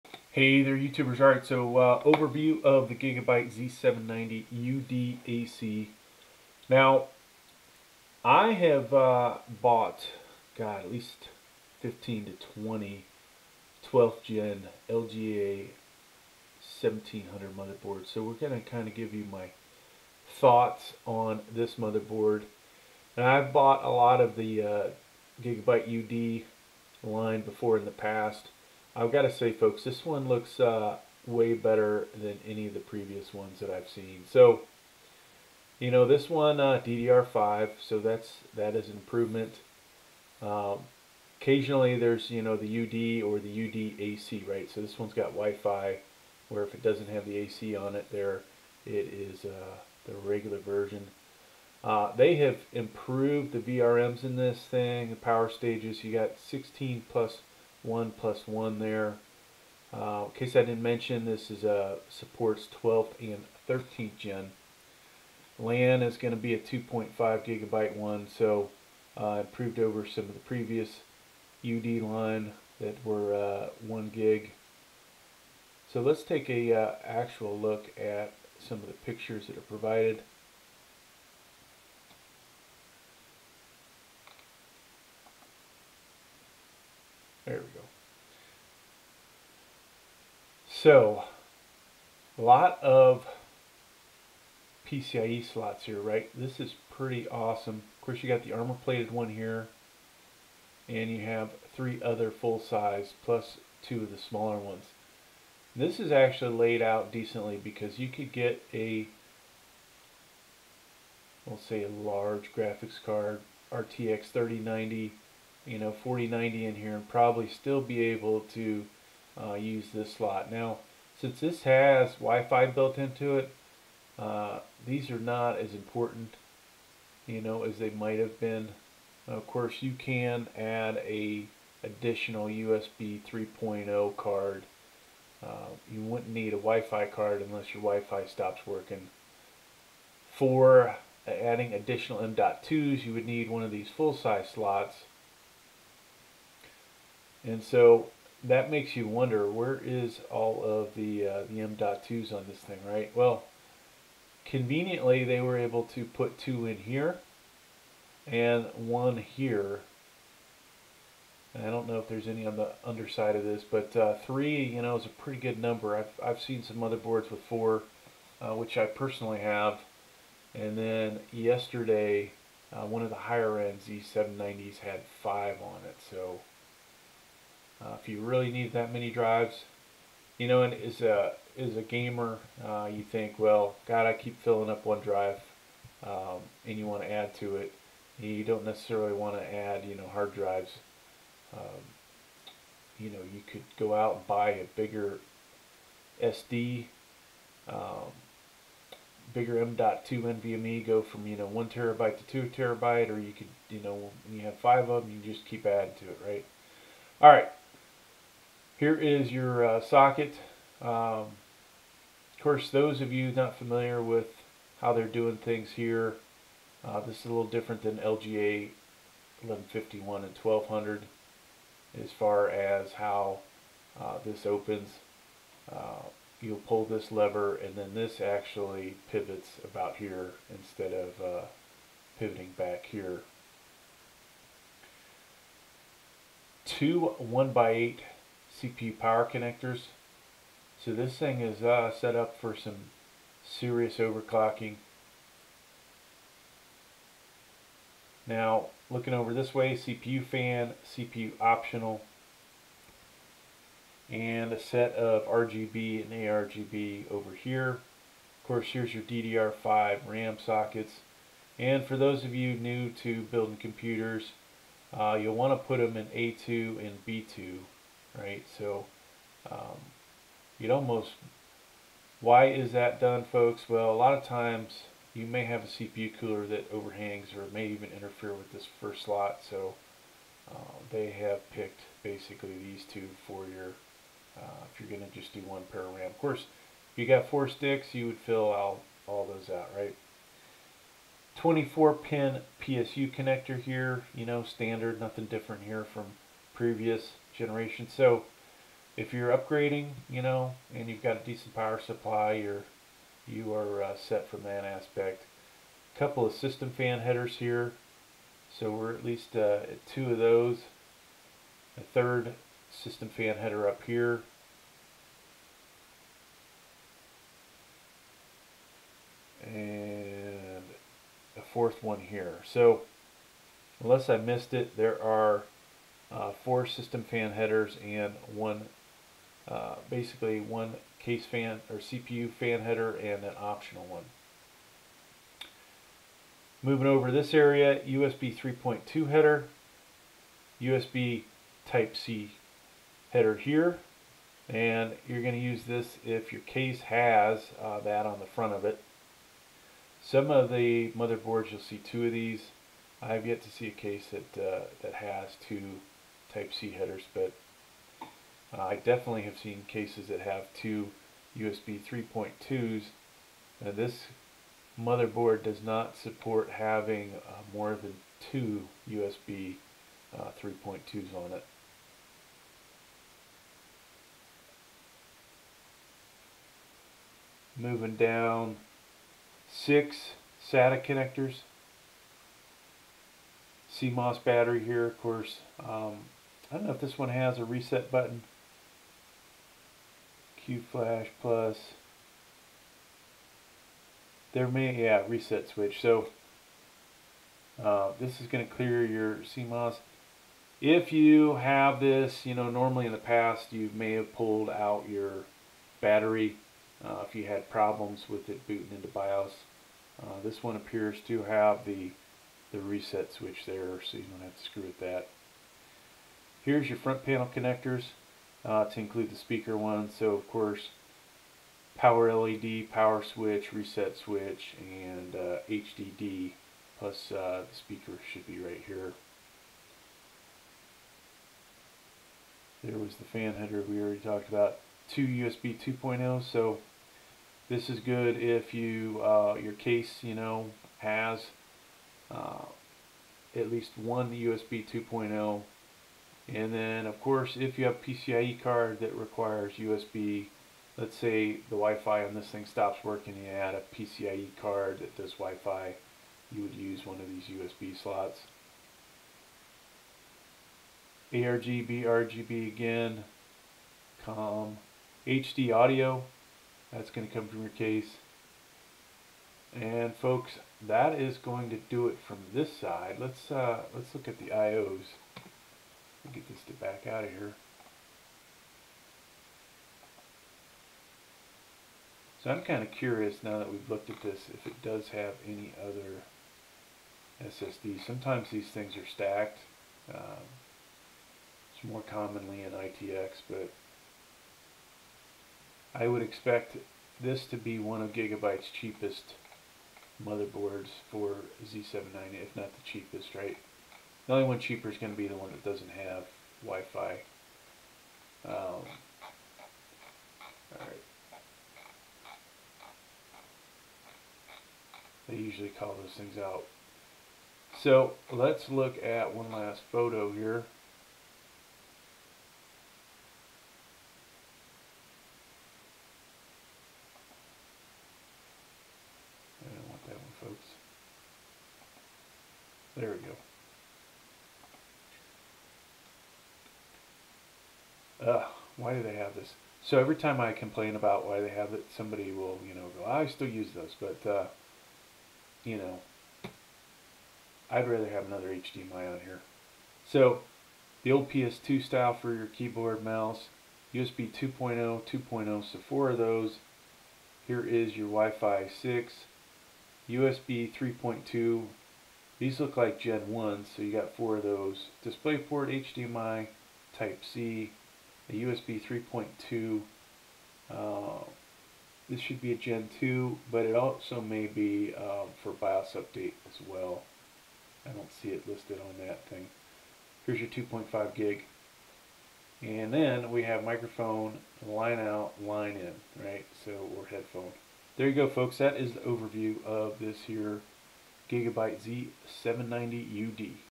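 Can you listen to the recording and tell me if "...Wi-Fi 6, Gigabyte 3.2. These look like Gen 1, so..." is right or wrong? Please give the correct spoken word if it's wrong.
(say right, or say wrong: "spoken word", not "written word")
wrong: "USB", not "Gigabyte".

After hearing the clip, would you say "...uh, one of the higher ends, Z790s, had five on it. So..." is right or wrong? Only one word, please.
right.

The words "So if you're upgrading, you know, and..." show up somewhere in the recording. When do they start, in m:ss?
4:57.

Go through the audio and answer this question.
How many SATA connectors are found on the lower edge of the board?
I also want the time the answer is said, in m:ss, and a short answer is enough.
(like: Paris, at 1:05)
6, at 6:19.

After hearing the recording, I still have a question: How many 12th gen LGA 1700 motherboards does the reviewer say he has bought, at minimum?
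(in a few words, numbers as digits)
15.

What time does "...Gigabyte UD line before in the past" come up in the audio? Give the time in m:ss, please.
0:25.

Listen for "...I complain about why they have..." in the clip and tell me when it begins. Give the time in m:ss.
9:00.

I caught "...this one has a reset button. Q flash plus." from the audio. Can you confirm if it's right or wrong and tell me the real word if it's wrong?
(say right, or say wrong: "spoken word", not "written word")
right.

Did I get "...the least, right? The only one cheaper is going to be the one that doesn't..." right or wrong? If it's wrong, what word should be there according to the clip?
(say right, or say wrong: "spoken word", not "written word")
wrong: "cheapest", not "least".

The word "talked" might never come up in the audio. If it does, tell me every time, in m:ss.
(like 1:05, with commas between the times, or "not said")
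7:13.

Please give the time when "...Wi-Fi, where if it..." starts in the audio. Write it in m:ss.
0:45.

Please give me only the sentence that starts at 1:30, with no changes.
So, a lot of PCIe slots here, right?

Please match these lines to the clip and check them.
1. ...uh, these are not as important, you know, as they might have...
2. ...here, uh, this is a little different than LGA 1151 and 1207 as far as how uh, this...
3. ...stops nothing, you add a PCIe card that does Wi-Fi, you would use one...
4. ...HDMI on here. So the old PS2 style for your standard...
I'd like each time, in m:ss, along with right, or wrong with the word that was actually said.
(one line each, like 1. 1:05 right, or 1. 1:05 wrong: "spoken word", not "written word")
1. 2:04 right
2. 3:35 wrong: "1200", not "1207"
3. 7:32 wrong: "working", not "nothing"
4. 9:08 wrong: "keyboard", not "standard".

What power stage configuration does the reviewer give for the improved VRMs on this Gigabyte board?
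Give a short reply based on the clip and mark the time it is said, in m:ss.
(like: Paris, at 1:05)
16 plus 1 plus 1, at 0:56.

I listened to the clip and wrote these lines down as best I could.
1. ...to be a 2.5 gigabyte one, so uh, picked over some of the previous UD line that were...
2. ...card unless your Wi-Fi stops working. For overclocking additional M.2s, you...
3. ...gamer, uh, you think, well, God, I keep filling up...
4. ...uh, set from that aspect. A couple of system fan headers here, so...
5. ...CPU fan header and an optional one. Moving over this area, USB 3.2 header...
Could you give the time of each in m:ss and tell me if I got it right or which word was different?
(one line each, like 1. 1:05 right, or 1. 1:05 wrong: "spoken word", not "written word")
1. 1:06 wrong: "improved", not "picked"
2. 2:17 wrong: "adding", not "overclocking"
3. 3:01 right
4. 5:03 right
5. 5:31 right.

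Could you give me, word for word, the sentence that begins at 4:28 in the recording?
So um, you'd almost, why is that done, folks?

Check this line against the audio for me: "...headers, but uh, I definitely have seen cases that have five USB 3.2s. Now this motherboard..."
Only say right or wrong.
wrong.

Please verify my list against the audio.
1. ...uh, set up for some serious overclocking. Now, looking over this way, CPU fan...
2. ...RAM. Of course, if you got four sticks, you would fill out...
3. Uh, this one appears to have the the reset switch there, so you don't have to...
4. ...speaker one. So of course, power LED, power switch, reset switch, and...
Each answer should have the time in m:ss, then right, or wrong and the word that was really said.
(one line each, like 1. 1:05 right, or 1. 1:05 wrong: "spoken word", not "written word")
1. 4:01 right
2. 4:45 right
3. 6:50 right
4. 6:59 right.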